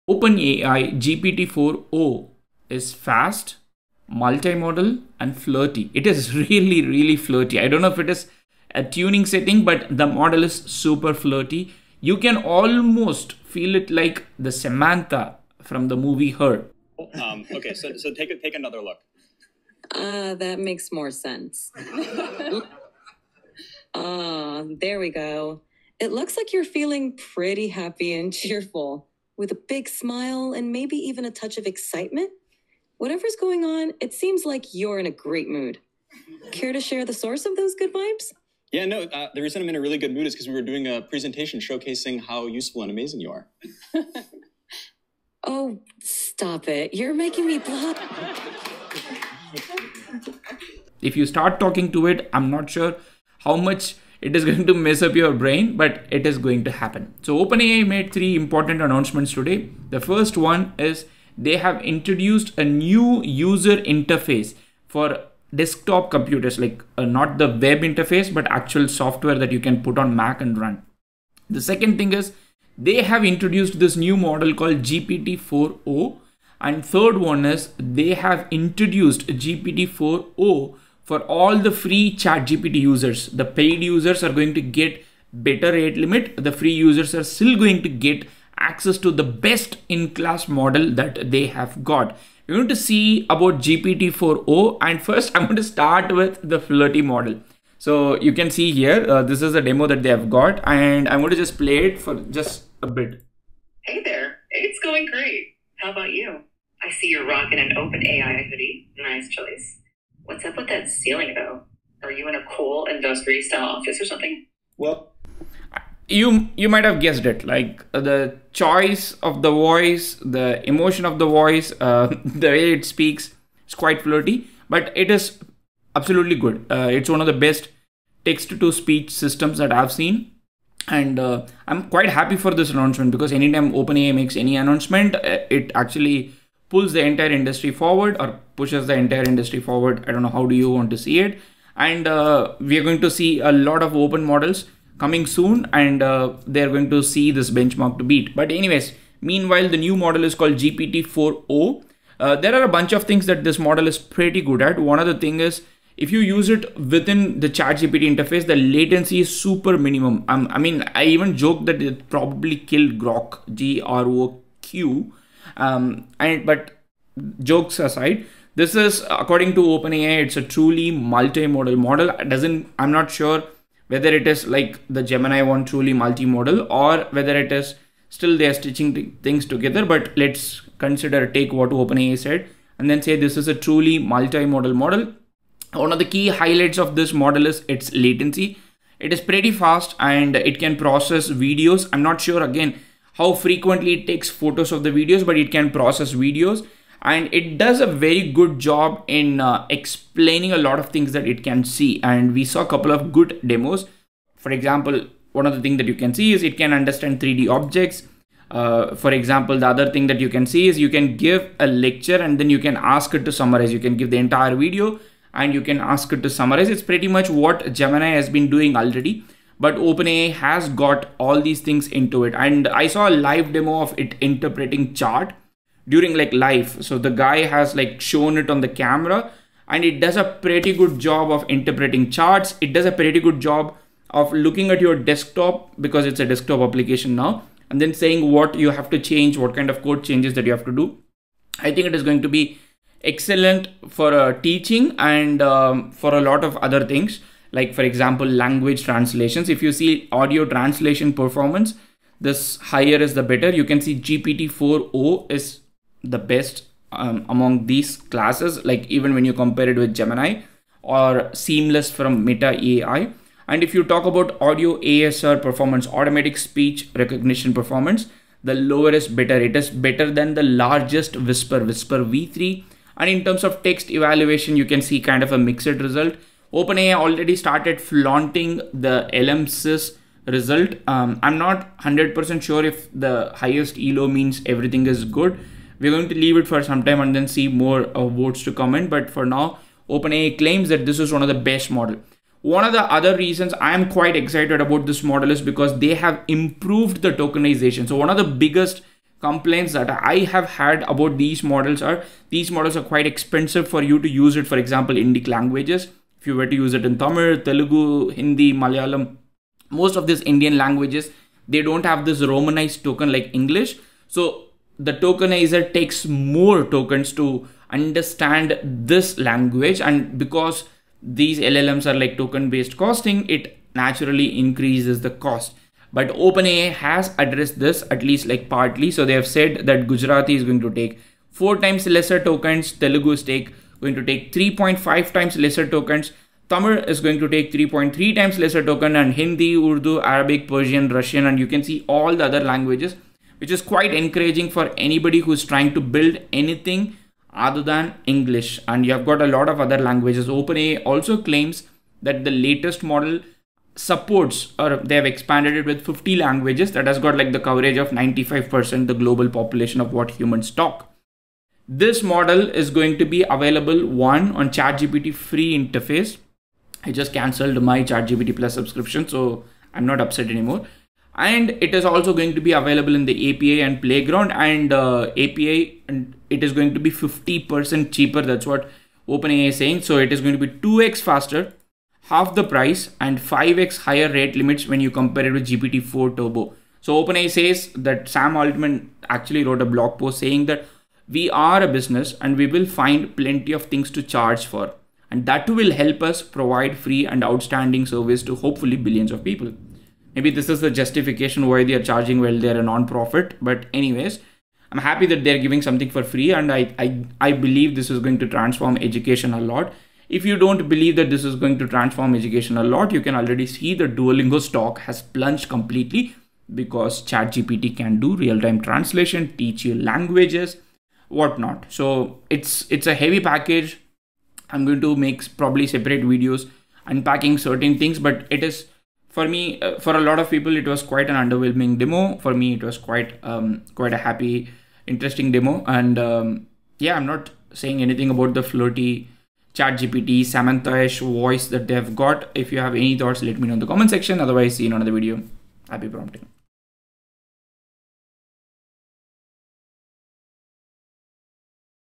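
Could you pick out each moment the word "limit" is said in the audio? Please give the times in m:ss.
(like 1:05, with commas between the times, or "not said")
1:25, 6:24.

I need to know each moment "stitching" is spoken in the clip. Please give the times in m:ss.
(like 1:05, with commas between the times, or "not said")
2:58.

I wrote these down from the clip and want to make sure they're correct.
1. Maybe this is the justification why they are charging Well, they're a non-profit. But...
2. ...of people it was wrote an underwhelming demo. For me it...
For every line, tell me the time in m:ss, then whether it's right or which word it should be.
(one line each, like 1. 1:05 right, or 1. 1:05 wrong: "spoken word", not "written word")
1. 6:40 right
2. 7:10 wrong: "quite", not "wrote".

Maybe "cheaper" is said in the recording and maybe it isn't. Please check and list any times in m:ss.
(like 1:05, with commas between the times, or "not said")
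6:17.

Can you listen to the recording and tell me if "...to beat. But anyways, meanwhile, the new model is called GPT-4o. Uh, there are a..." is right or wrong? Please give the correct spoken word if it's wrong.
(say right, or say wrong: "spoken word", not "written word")
right.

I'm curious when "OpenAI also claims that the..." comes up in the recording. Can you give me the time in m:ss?
5:50.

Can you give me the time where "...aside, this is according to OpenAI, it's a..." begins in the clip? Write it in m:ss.
2:47.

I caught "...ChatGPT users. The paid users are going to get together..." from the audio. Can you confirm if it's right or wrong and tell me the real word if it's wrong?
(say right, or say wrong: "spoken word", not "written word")
wrong: "better", not "together".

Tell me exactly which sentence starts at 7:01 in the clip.
So it's it's a heavy package.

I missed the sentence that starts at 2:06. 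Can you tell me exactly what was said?
Uh, it's one of the best text to speech systems that I've seen.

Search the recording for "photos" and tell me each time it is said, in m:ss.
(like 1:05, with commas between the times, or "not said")
3:14.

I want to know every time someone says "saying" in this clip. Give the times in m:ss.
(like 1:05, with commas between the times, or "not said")
3:57, 6:19, 6:30, 7:17.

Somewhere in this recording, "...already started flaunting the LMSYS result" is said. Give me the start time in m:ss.
4:36.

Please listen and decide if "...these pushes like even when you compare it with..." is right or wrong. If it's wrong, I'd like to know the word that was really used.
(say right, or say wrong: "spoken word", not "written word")
wrong: "classes", not "pushes".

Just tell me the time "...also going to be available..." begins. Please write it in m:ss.
6:11.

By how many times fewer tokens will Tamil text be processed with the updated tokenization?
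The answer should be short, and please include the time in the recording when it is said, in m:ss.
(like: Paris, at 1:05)
3.3, at 5:37.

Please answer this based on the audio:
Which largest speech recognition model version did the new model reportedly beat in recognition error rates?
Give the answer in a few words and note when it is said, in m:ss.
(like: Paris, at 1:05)
Whisper v3, at 4:31.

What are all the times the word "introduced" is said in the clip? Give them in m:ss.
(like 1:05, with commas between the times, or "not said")
1:01, 1:13, 1:18.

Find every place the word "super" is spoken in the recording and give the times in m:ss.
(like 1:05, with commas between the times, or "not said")
0:10, 2:39.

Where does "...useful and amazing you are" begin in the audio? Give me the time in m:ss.
0:42.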